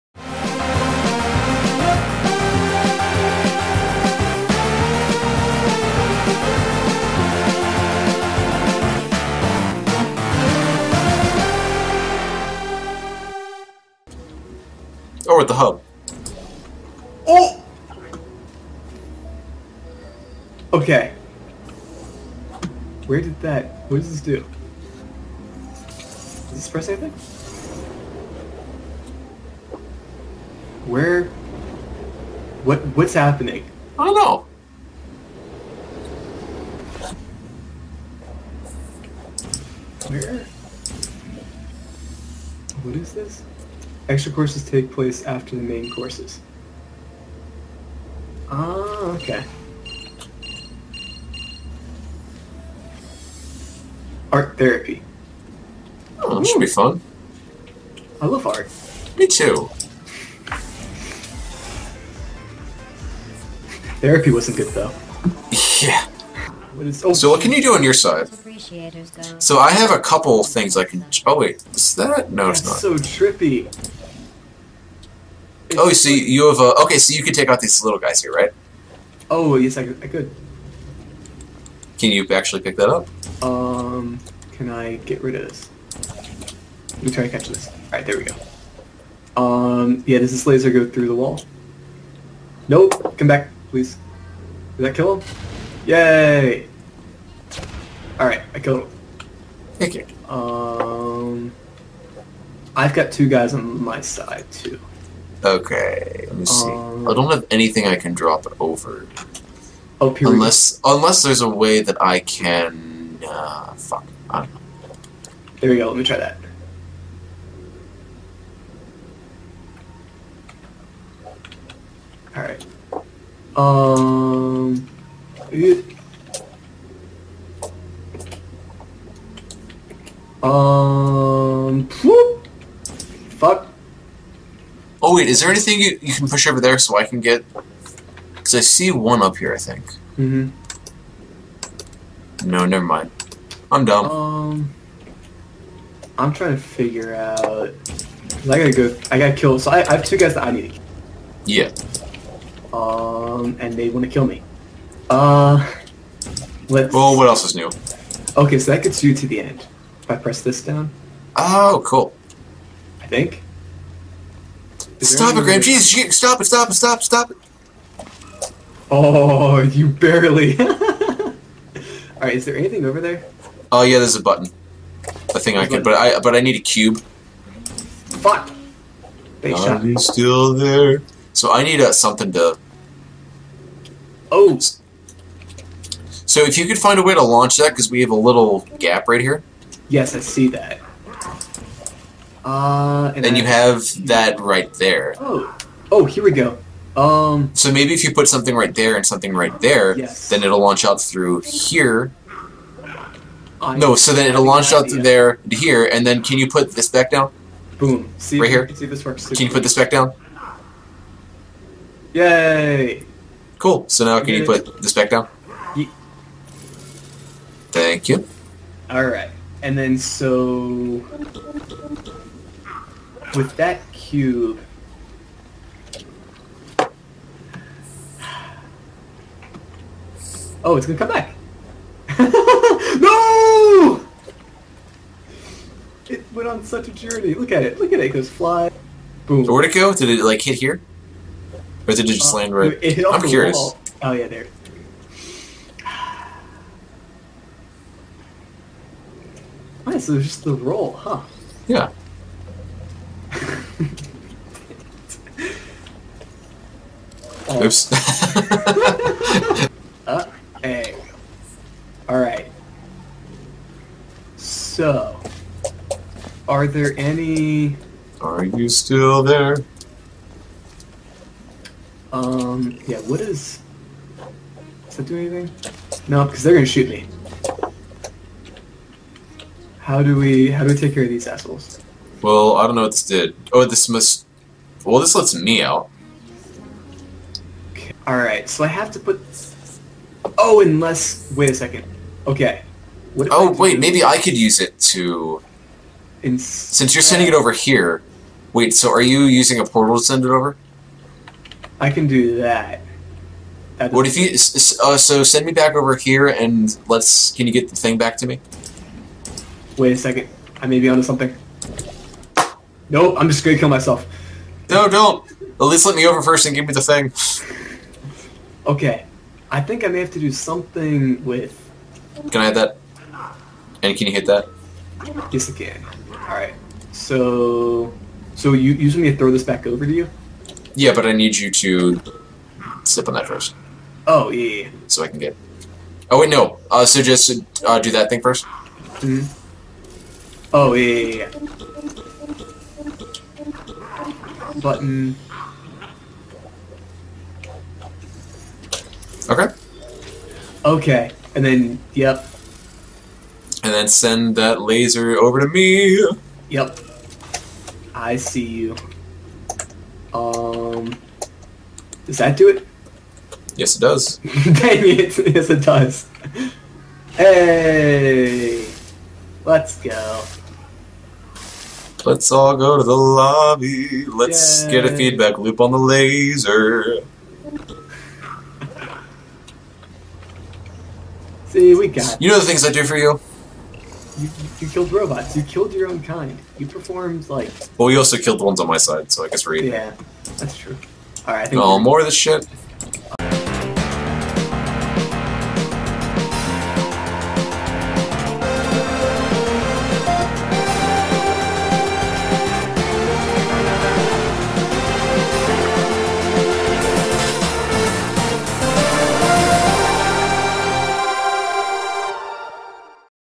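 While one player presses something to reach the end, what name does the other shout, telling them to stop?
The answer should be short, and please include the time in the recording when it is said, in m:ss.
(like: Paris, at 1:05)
Graham, at 2:45.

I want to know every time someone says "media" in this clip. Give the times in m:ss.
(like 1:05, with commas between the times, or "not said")
not said.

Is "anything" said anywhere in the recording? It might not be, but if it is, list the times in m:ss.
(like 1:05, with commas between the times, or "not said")
0:26, 1:47, 2:15, 2:52, 4:35.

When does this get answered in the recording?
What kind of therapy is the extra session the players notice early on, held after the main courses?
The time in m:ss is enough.
0:54.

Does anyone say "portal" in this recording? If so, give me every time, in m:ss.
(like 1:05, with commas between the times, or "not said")
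4:59.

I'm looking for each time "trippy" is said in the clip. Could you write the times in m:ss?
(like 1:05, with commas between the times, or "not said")
1:12.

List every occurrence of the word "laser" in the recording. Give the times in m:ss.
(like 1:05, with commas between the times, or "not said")
1:30, 5:54, 6:15.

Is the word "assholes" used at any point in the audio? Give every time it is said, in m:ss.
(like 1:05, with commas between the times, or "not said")
4:41.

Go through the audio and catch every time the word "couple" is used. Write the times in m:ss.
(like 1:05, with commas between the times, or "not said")
1:09.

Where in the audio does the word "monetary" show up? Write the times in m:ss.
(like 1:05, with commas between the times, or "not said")
not said.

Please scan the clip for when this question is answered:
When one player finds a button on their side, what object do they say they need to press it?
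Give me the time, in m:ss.
2:56.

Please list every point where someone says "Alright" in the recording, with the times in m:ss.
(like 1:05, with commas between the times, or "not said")
2:02, 2:50, 4:22, 4:48.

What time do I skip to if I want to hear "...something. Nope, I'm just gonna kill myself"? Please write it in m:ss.
5:11.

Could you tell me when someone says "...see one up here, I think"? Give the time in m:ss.
2:18.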